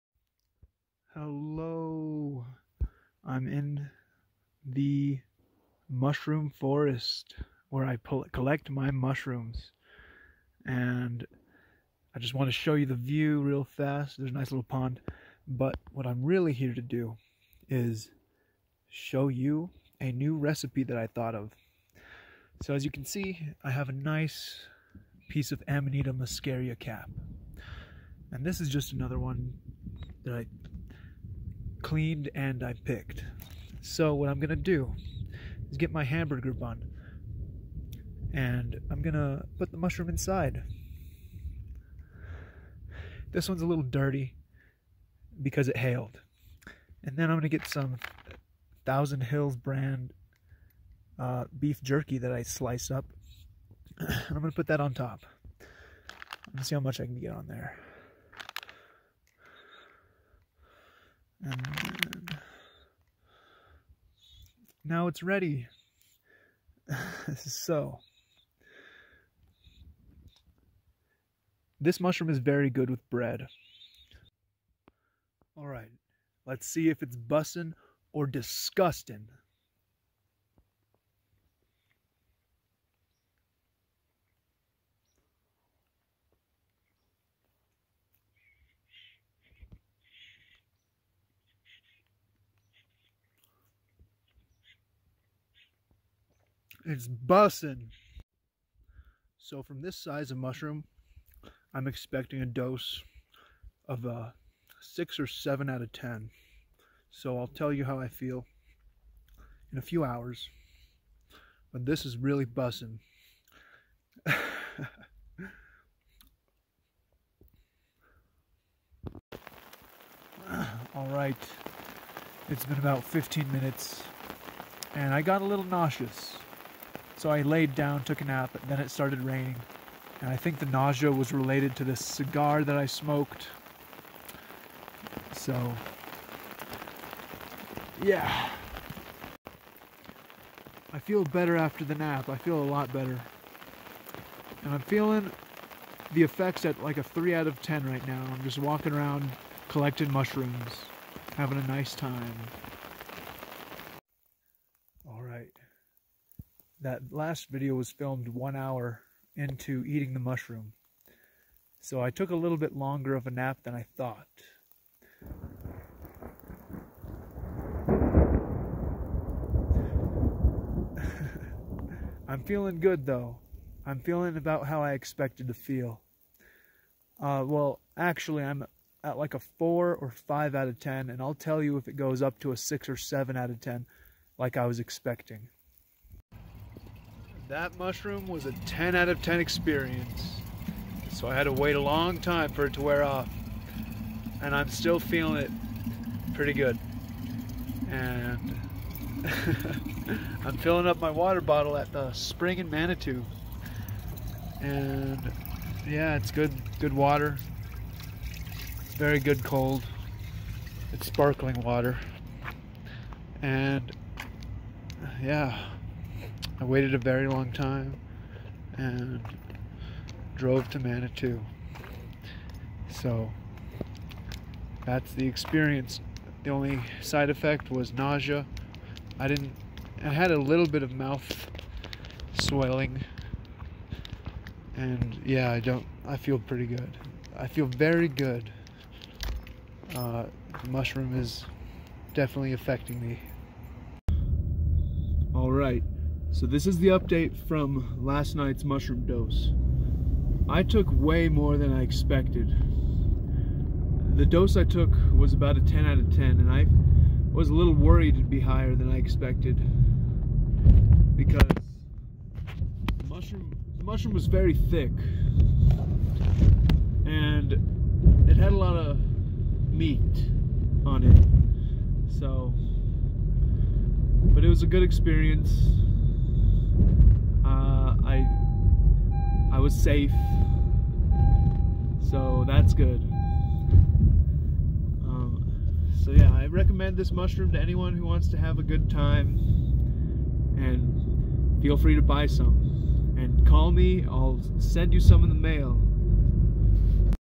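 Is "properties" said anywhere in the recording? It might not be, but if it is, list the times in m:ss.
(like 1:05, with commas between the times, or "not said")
not said.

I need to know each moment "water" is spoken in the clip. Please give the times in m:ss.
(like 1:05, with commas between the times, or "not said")
3:21, 3:26, 3:31.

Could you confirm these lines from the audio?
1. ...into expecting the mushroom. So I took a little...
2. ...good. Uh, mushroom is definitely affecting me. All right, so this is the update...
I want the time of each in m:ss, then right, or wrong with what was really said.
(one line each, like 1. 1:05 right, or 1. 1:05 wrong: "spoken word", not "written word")
1. 2:39 wrong: "eating", not "expecting"
2. 3:58 right.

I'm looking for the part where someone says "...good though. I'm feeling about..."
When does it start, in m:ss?
2:52.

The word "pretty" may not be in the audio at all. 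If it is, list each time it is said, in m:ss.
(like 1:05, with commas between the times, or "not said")
3:16, 3:56.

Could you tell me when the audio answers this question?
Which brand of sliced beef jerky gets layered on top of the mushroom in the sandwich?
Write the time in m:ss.
0:48.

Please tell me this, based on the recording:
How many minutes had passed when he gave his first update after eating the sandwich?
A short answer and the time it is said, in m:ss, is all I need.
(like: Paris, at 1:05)
15, at 2:03.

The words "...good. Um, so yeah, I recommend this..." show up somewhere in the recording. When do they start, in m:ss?
4:42.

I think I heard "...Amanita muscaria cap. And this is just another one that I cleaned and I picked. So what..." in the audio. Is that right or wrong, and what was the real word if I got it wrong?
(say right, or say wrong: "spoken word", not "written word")
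right.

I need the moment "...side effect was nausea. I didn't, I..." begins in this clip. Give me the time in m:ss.
3:47.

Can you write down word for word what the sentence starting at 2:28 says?
I'm just walking around collecting mushrooms, having a nice time.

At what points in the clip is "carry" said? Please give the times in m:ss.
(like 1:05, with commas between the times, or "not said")
not said.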